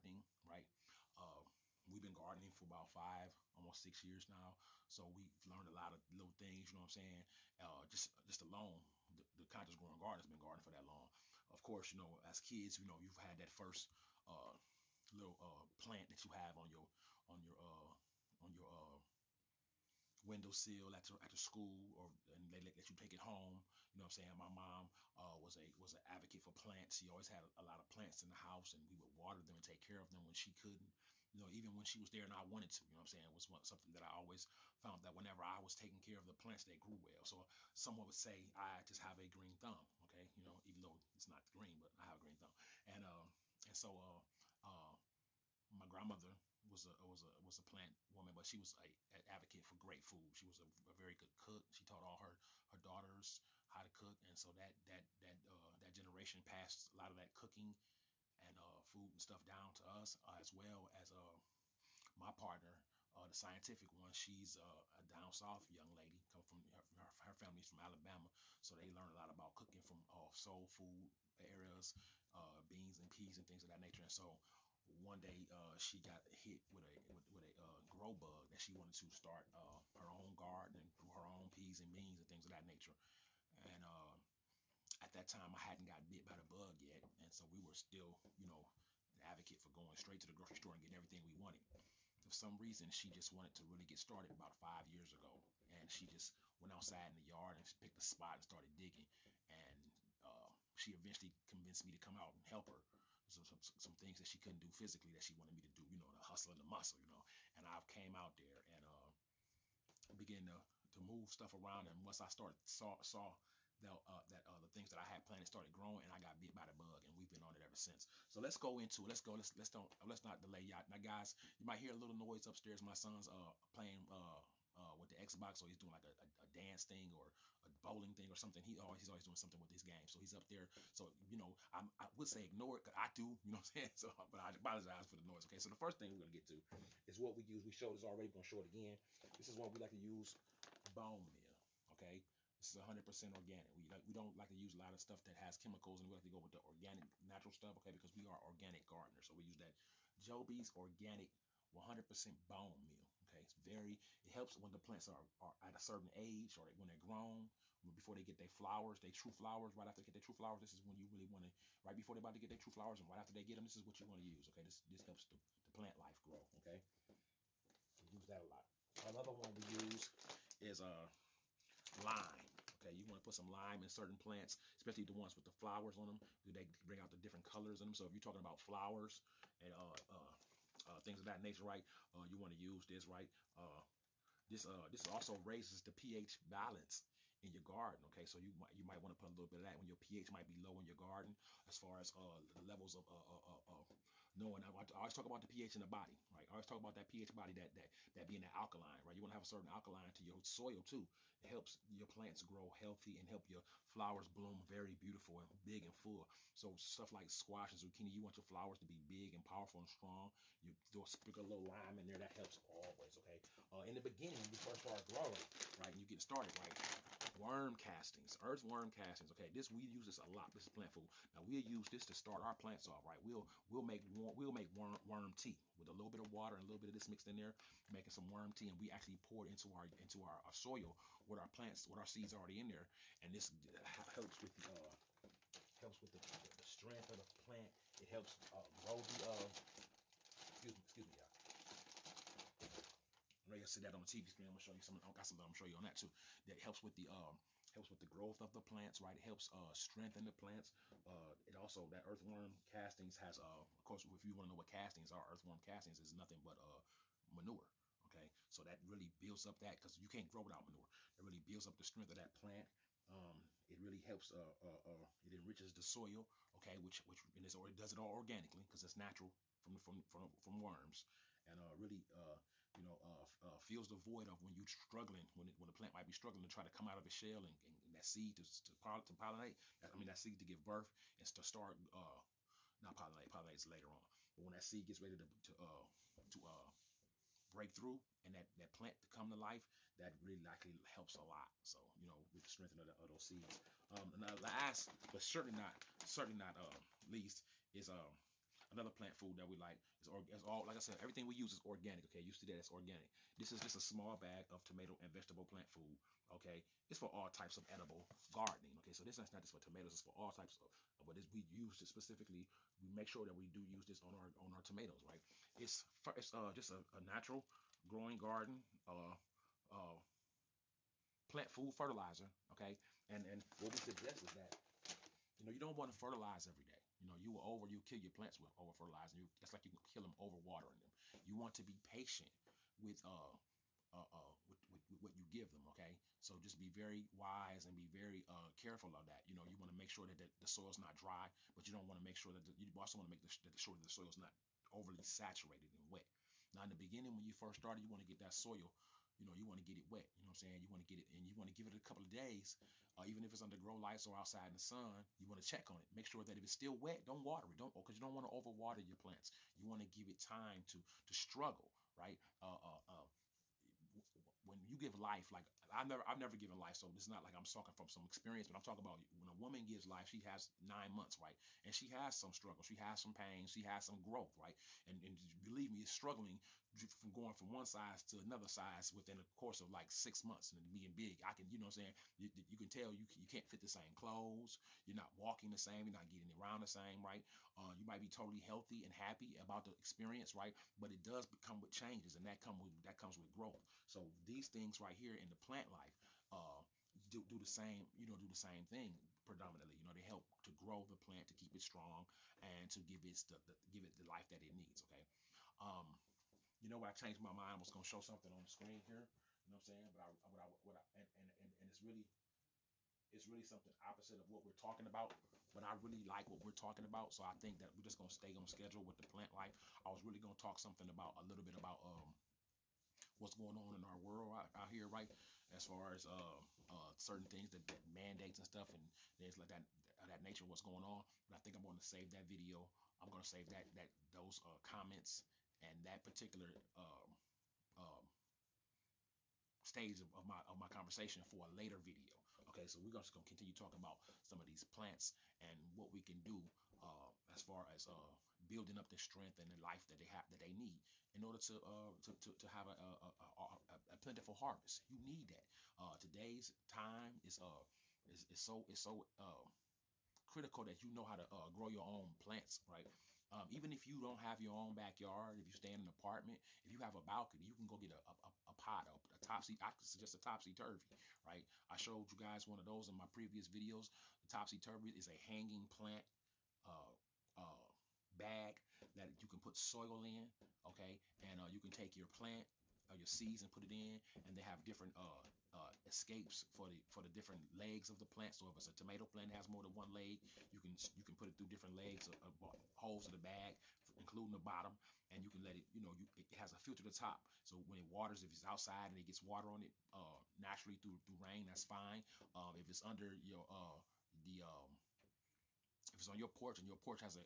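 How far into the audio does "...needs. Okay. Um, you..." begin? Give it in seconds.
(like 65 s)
404 s.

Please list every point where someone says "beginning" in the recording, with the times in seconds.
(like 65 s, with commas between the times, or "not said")
214 s, 346 s.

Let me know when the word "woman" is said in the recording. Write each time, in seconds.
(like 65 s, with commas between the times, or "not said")
48 s, 369 s.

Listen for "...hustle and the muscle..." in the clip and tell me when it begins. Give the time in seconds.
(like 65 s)
106 s.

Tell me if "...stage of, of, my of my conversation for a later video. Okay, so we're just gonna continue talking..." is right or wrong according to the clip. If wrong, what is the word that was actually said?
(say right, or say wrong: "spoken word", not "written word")
right.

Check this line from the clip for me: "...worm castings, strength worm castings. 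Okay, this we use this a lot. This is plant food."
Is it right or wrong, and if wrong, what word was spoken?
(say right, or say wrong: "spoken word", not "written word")
wrong: "earth", not "strength".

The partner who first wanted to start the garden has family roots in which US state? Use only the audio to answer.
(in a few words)
Alabama.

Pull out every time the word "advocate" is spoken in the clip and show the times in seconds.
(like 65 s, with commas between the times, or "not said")
26 s, 49 s, 89 s.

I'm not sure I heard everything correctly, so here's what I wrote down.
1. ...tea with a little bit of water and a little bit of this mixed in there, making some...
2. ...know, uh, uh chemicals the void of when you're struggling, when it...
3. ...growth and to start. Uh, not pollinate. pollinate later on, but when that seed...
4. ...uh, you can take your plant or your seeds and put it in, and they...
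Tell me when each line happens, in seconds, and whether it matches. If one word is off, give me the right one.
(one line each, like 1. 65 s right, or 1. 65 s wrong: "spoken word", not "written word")
1. 225 s right
2. 272 s wrong: "fills", not "chemicals"
3. 280 s wrong: "birth", not "growth"
4. 481 s right.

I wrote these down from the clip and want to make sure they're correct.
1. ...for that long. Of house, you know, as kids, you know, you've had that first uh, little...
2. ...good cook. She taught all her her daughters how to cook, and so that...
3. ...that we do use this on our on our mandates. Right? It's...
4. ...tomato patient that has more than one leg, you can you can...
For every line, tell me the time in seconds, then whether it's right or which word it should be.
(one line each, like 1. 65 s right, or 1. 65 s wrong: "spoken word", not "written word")
1. 10 s wrong: "course", not "house"
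2. 51 s right
3. 313 s wrong: "tomatoes", not "mandates"
4. 488 s wrong: "plant", not "patient".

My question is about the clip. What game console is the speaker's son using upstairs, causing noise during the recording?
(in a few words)
Xbox.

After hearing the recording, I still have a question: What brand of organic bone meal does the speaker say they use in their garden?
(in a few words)
Jobe's.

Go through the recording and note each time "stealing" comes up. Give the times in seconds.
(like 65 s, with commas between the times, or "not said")
not said.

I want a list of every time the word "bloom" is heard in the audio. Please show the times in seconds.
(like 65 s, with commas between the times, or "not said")
204 s.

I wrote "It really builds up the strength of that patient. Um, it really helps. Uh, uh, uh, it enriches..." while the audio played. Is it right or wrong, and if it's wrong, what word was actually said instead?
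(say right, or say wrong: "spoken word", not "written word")
wrong: "plant", not "patient".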